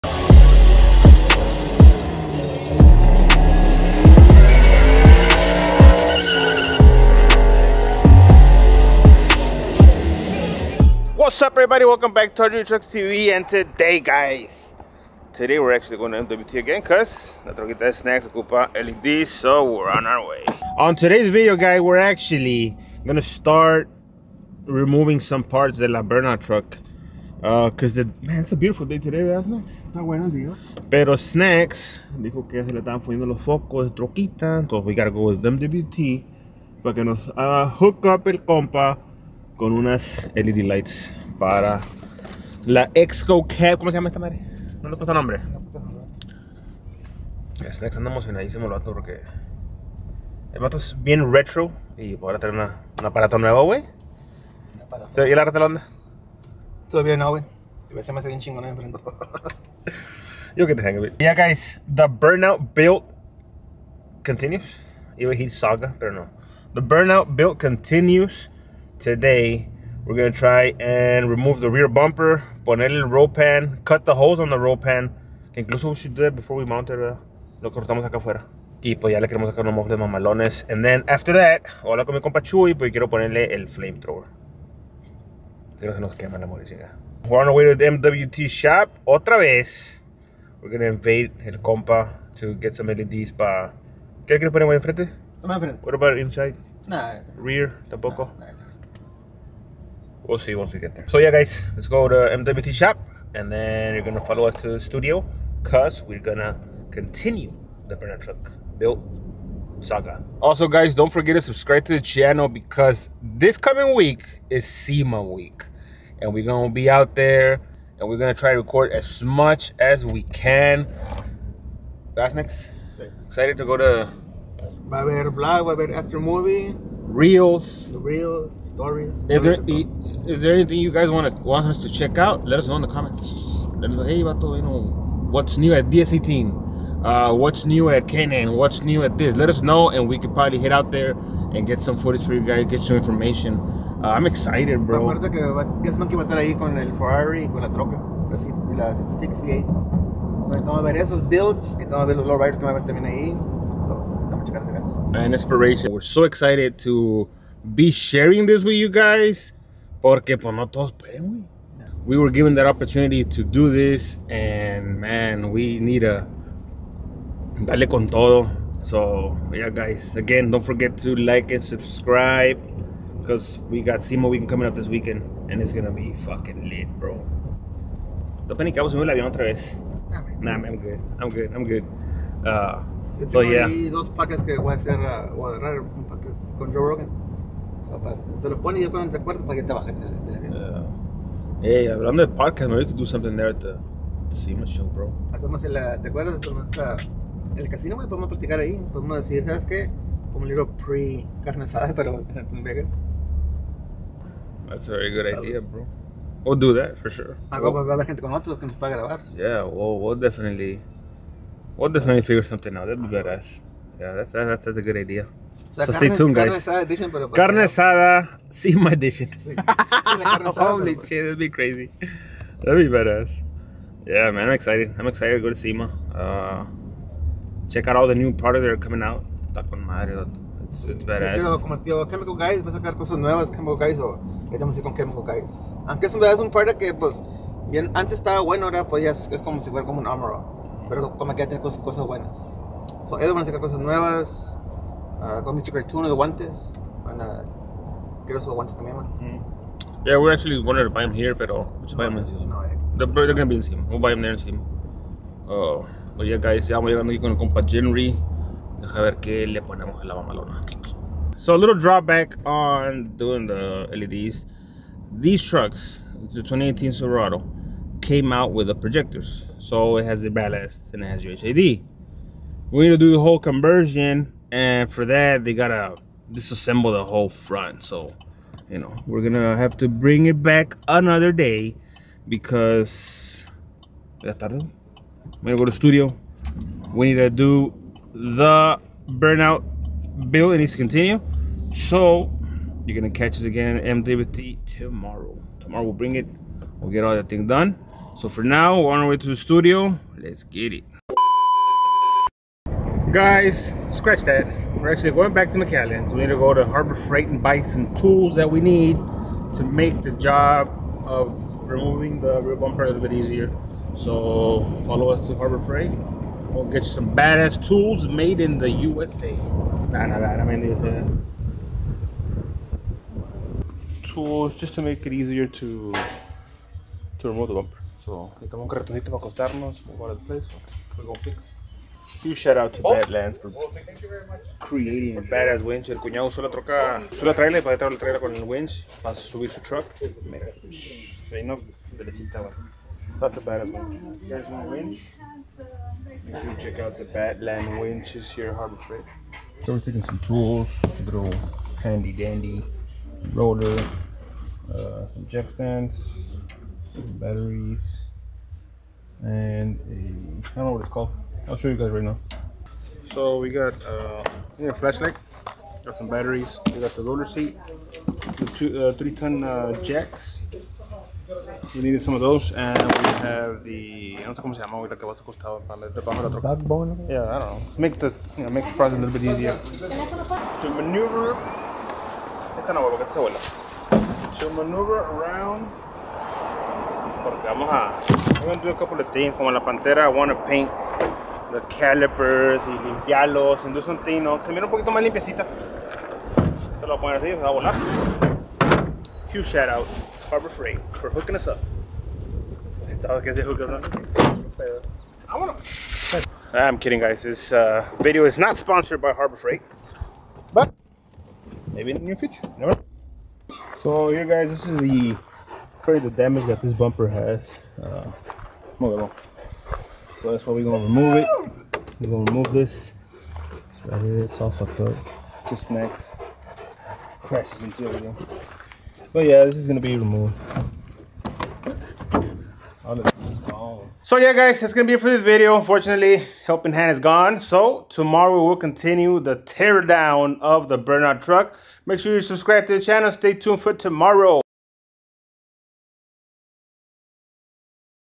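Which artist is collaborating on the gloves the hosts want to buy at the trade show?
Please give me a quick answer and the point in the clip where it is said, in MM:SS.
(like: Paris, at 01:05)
Mr. Cartoon, at 04:05.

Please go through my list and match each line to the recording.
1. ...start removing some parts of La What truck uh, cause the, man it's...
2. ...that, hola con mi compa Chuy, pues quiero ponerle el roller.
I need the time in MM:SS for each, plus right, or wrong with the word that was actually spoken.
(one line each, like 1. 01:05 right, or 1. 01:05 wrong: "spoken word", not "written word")
1. 00:23 wrong: "Berna", not "What"
2. 01:21 wrong: "flamethrower", not "roller".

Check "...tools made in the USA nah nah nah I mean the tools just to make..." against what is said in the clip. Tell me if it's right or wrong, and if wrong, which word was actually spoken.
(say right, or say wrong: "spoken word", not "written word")
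right.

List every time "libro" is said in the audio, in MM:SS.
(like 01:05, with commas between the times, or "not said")
03:20.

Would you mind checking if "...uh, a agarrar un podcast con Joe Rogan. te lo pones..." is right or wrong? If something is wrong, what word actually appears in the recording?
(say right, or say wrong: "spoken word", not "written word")
right.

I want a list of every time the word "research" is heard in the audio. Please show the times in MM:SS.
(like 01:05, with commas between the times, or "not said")
not said.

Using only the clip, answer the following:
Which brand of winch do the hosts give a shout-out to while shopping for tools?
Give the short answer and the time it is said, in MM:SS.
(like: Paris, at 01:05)
Badlands, at 05:32.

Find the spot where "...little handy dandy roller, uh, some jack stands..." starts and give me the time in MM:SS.
05:51.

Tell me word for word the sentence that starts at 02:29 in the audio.
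So, estamos a ver esos builds, estamos a ver los lowriders que van a ver también ahí and inspiration.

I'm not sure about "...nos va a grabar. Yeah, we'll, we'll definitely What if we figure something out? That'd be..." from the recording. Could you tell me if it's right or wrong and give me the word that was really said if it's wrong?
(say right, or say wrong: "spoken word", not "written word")
right.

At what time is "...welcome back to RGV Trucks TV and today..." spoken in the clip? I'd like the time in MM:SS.
00:11.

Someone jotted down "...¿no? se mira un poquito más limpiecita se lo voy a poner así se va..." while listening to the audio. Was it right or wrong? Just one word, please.
right.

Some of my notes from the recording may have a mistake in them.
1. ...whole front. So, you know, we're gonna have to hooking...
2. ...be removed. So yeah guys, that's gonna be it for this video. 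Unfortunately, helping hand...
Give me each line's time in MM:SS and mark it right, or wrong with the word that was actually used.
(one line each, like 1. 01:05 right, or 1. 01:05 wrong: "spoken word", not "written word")
1. 04:37 wrong: "bring", not "hooking"
2. 07:09 right.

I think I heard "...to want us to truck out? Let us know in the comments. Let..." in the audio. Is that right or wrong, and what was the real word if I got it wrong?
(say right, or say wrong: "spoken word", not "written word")
wrong: "check", not "truck".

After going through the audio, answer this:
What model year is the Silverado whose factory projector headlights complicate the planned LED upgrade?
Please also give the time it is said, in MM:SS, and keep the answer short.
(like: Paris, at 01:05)
2018, at 04:26.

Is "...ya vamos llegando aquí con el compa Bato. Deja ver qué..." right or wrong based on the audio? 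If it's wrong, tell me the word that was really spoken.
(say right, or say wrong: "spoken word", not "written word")
wrong: "Jenry", not "Bato".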